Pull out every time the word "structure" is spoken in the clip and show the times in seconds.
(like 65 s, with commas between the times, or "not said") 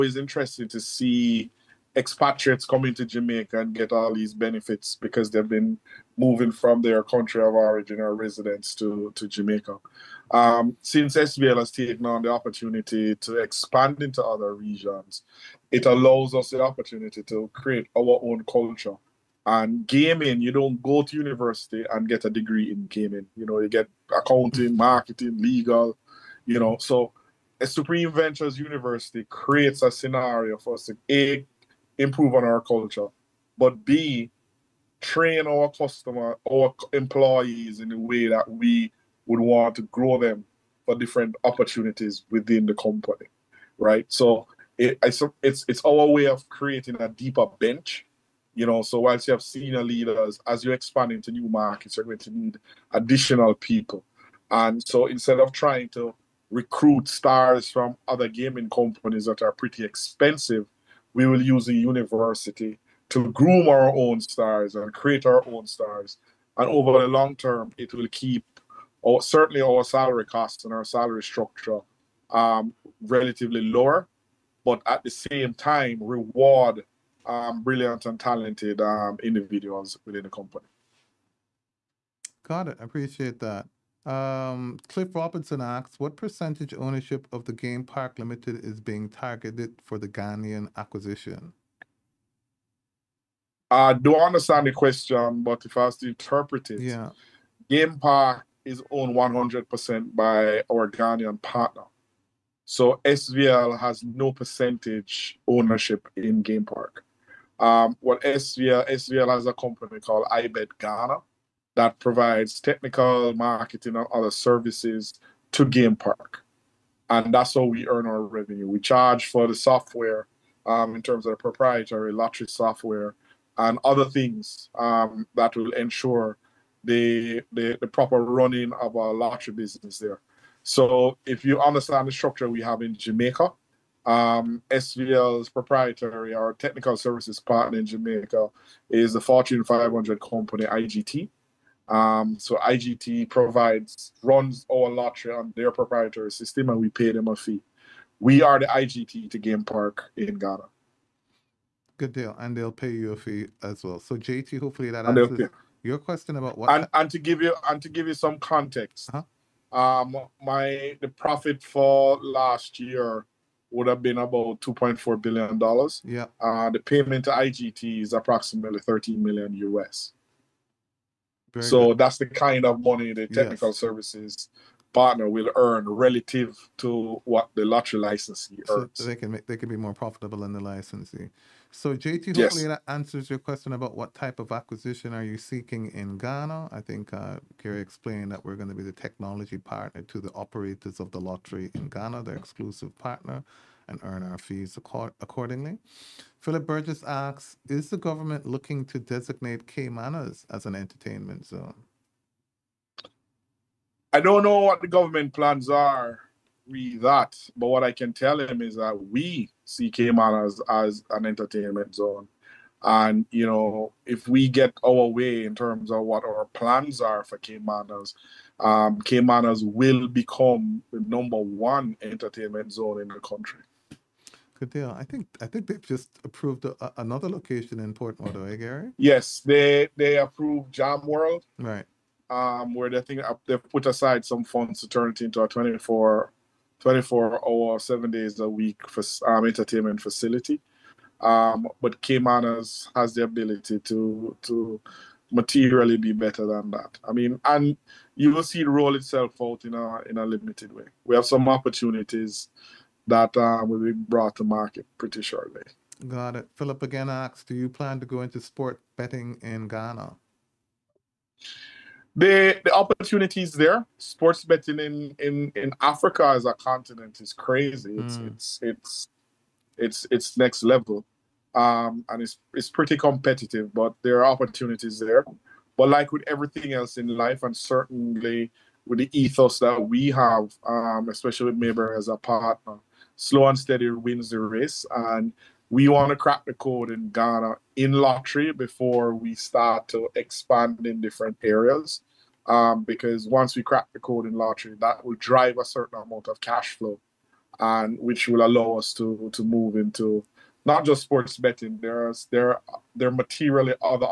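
71 s, 132 s.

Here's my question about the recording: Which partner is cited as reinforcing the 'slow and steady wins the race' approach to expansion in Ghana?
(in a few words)
Mayberry.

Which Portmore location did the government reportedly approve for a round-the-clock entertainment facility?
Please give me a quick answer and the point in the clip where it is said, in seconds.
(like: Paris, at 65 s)
Jamworld, at 230 s.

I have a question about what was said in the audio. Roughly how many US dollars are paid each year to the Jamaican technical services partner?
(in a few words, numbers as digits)
13 million US.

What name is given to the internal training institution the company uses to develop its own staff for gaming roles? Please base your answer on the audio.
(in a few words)
Supreme Ventures University.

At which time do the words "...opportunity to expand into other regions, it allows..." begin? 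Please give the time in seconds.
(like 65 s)
12 s.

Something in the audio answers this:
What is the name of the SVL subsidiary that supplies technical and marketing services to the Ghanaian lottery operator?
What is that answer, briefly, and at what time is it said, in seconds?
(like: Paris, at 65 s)
IBET Ghana, at 110 s.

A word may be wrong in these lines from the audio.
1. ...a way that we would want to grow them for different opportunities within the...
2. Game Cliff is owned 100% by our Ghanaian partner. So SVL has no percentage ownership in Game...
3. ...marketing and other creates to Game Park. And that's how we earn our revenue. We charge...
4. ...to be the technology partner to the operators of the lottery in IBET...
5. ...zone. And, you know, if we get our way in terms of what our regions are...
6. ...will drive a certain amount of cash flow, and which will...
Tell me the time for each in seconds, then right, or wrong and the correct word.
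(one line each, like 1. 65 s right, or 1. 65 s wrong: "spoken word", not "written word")
1. 37 s right
2. 97 s wrong: "Park", not "Cliff"
3. 113 s wrong: "services", not "creates"
4. 188 s wrong: "Ghana", not "IBET"
5. 211 s wrong: "plans", not "regions"
6. 295 s right.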